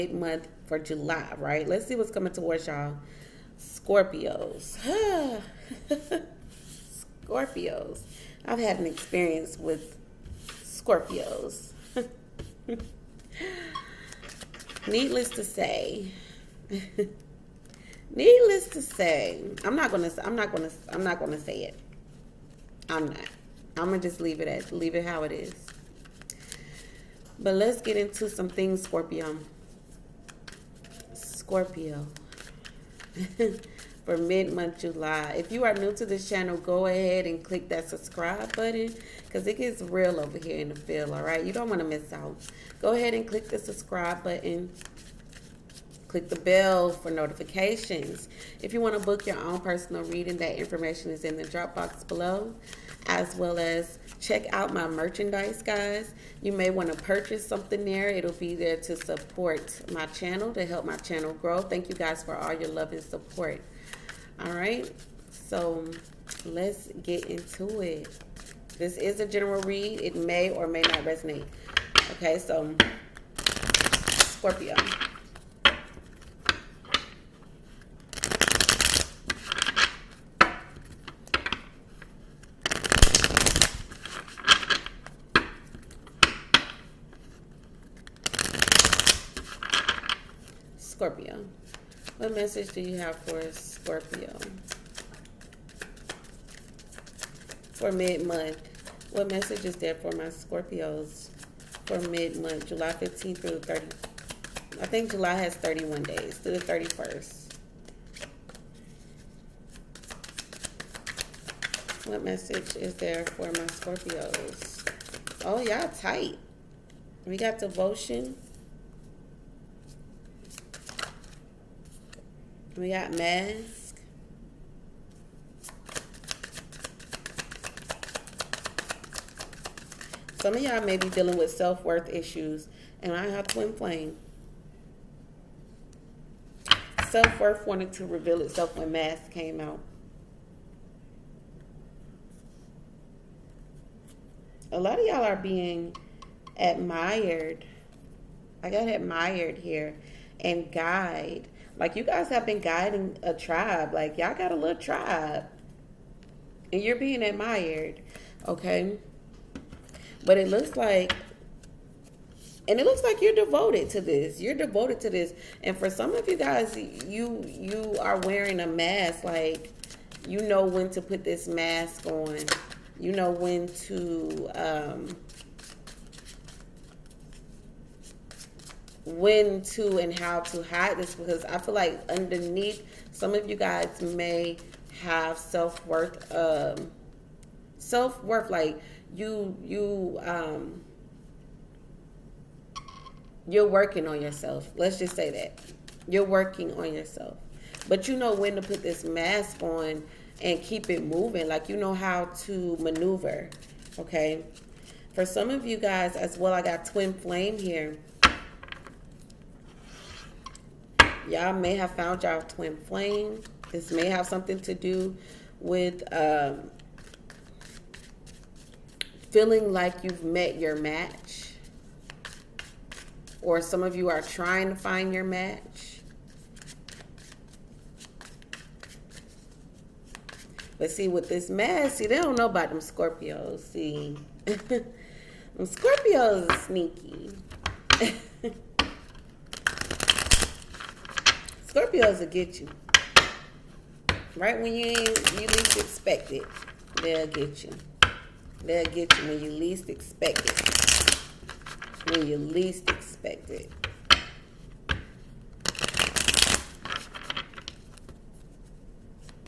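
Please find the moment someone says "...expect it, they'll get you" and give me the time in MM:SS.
04:05.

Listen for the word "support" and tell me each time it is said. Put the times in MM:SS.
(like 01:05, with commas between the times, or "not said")
00:58, 01:03.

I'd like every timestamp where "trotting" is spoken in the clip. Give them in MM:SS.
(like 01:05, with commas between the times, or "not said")
not said.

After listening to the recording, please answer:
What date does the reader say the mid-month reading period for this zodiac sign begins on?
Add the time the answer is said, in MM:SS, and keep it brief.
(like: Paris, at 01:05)
July 15th, at 01:42.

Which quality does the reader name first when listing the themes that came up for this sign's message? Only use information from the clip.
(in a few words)
Devotion.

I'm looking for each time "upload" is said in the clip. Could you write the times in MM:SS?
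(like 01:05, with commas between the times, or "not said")
not said.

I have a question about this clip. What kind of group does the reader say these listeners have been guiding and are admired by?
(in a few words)
A tribe.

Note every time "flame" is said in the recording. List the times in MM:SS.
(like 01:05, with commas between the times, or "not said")
02:13, 03:27, 03:32.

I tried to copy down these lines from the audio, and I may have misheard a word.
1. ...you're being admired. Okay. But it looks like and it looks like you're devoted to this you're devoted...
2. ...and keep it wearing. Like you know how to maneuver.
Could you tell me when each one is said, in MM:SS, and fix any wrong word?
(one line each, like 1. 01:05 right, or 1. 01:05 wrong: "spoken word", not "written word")
1. 02:36 right
2. 03:20 wrong: "moving", not "wearing".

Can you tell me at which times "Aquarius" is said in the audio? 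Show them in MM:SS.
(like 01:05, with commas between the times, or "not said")
not said.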